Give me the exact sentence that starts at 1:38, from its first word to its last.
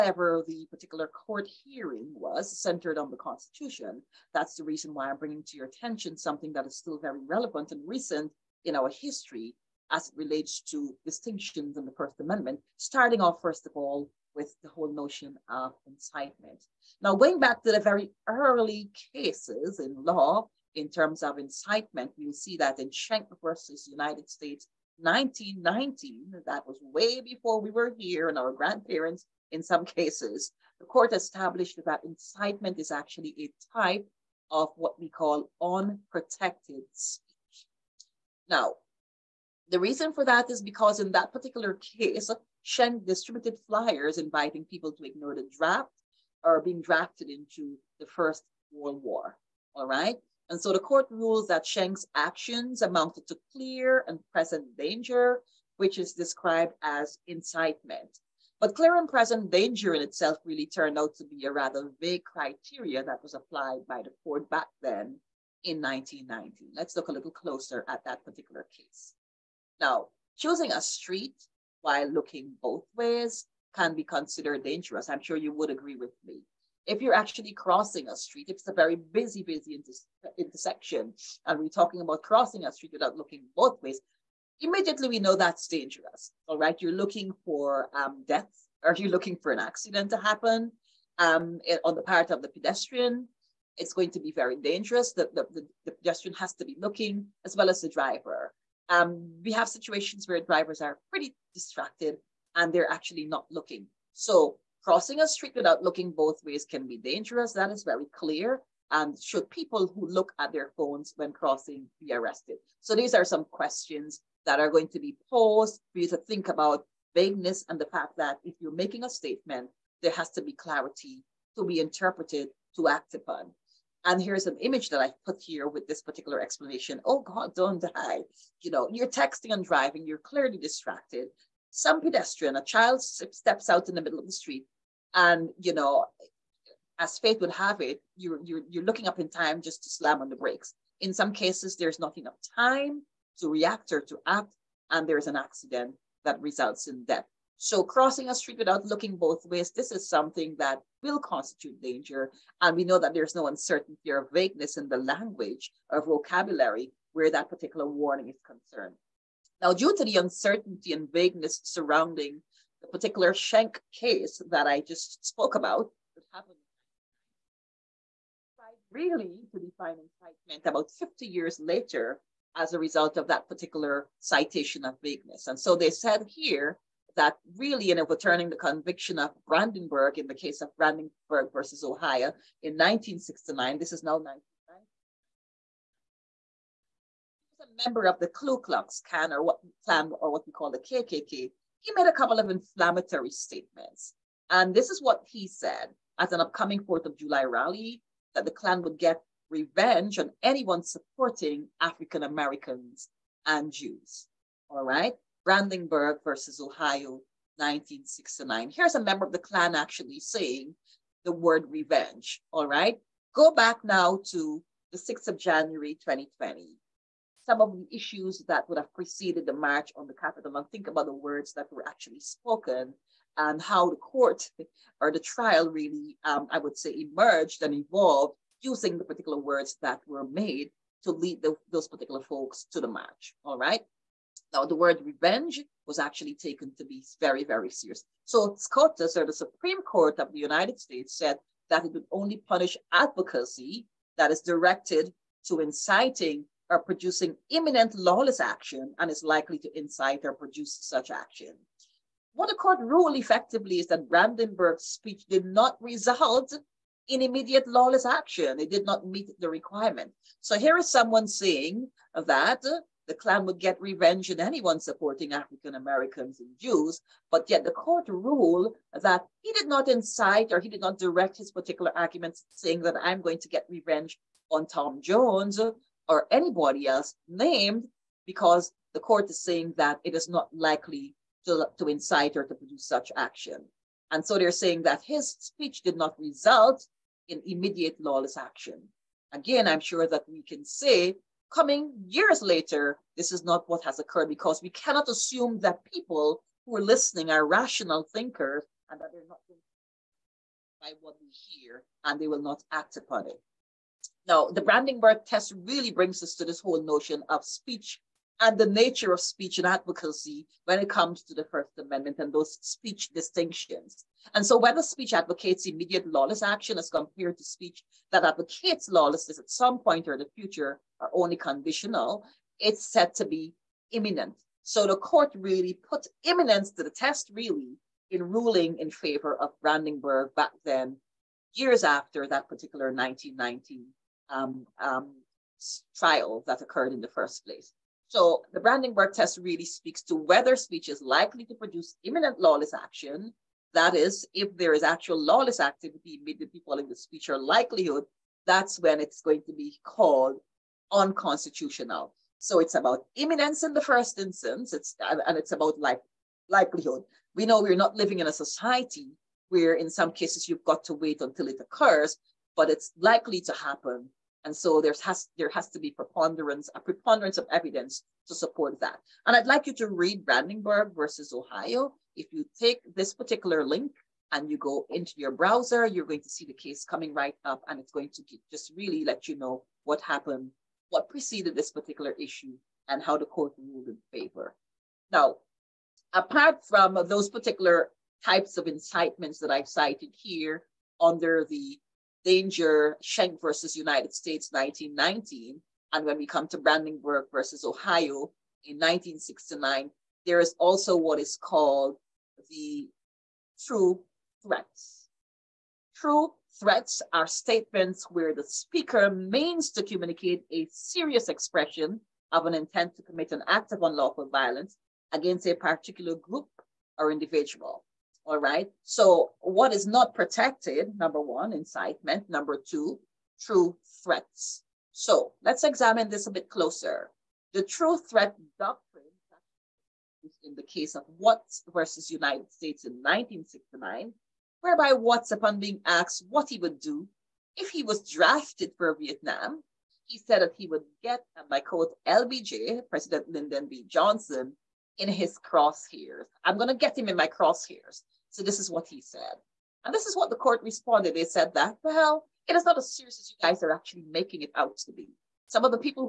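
Um, we have situations where drivers are pretty distracted and they're actually not looking.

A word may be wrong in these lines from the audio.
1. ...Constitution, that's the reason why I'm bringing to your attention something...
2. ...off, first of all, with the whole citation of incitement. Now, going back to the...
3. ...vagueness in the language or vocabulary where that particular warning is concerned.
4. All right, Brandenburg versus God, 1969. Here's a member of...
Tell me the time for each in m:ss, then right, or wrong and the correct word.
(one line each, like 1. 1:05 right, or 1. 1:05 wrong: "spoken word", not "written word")
1. 0:03 right
2. 0:13 wrong: "notion", not "citation"
3. 2:34 right
4. 3:24 wrong: "Ohio", not "God".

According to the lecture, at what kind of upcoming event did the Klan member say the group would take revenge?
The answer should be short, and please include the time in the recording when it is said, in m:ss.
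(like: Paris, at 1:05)
4th of July rally, at 3:16.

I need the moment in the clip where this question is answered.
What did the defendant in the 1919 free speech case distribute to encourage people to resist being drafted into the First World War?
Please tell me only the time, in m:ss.
0:43.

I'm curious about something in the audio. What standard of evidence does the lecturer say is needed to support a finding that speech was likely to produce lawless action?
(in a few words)
Preponderance of evidence.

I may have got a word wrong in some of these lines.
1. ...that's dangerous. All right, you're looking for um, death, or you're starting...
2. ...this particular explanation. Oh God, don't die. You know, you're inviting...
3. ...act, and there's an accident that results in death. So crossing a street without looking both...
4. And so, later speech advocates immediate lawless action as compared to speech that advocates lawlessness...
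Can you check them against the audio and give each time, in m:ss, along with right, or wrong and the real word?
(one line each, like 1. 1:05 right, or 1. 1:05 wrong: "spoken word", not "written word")
1. 1:25 wrong: "looking", not "starting"
2. 2:05 wrong: "texting", not "inviting"
3. 2:24 right
4. 5:14 wrong: "whether", not "later".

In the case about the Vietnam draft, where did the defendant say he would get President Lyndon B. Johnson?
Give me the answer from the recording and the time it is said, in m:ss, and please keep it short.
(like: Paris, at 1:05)
In his crosshairs, at 7:24.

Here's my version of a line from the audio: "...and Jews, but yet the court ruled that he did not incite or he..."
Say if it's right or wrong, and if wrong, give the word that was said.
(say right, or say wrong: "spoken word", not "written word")
right.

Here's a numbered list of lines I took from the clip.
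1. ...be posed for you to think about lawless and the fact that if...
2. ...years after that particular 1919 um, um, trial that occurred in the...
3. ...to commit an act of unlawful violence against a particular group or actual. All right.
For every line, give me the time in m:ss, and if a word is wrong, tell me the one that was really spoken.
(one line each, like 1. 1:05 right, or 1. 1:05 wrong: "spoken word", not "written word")
1. 1:54 wrong: "vagueness", not "lawless"
2. 5:31 right
3. 6:52 wrong: "individual", not "actual".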